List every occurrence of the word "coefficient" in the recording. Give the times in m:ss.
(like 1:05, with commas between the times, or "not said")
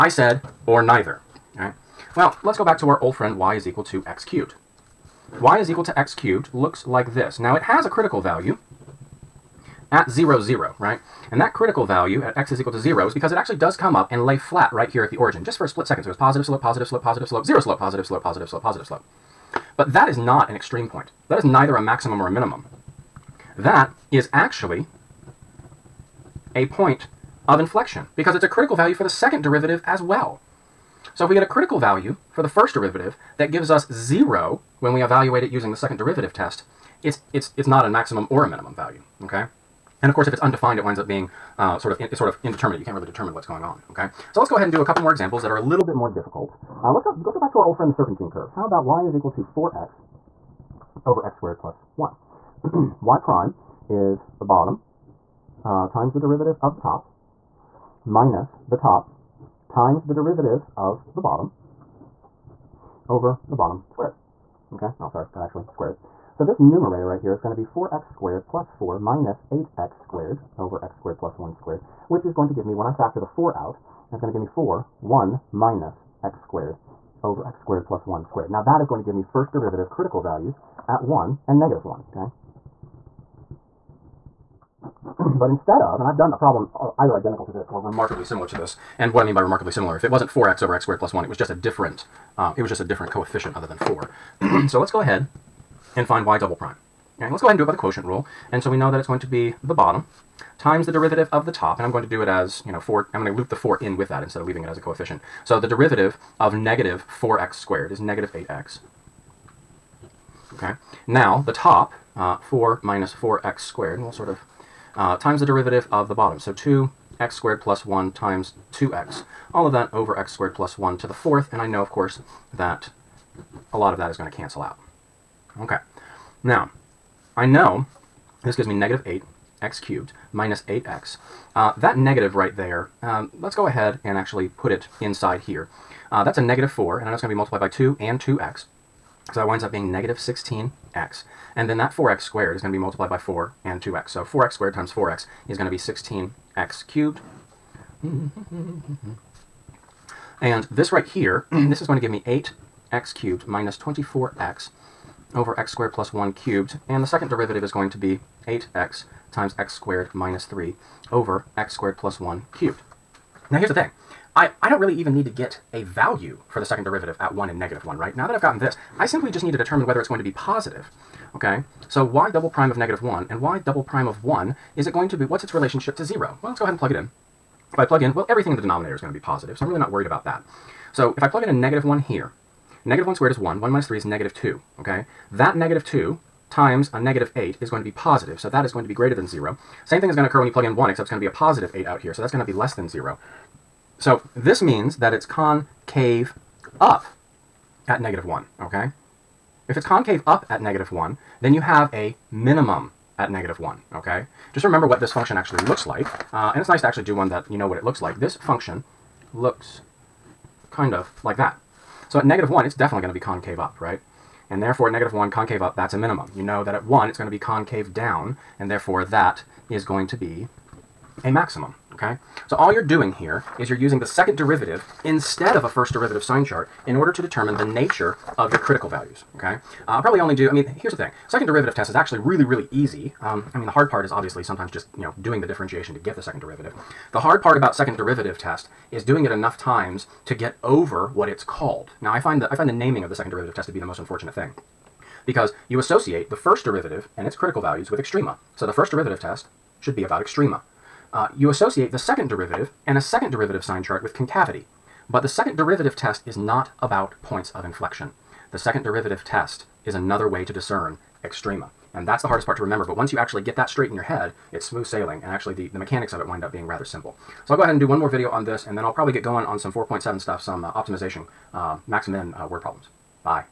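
1:33, 1:44.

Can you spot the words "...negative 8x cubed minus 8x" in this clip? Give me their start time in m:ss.
2:08.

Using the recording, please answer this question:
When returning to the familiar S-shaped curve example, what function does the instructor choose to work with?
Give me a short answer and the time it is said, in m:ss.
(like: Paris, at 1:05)
y = 4x/(x^2+1), at 0:48.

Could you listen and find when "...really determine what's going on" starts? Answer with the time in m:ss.
0:42.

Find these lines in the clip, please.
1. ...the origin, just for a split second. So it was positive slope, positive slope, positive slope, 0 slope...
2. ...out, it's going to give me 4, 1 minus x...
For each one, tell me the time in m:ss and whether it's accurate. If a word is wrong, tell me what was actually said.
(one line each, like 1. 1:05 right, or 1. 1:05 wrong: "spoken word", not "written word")
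1. 0:15 right
2. 1:13 right.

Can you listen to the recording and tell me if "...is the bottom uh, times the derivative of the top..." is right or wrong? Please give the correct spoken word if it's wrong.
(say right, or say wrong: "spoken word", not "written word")
right.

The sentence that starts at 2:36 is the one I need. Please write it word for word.
And the second derivative is going to be 8x times x squared minus 3 over x squared plus 1 cubed.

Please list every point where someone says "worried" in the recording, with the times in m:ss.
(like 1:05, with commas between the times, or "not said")
2:59.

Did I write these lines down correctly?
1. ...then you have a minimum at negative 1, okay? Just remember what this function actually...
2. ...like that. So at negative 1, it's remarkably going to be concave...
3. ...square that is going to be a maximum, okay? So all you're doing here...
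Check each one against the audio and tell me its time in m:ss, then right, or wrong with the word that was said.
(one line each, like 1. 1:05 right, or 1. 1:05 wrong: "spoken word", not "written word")
1. 3:21 right
2. 3:31 wrong: "definitely", not "remarkably"
3. 3:38 wrong: "therefore", not "square".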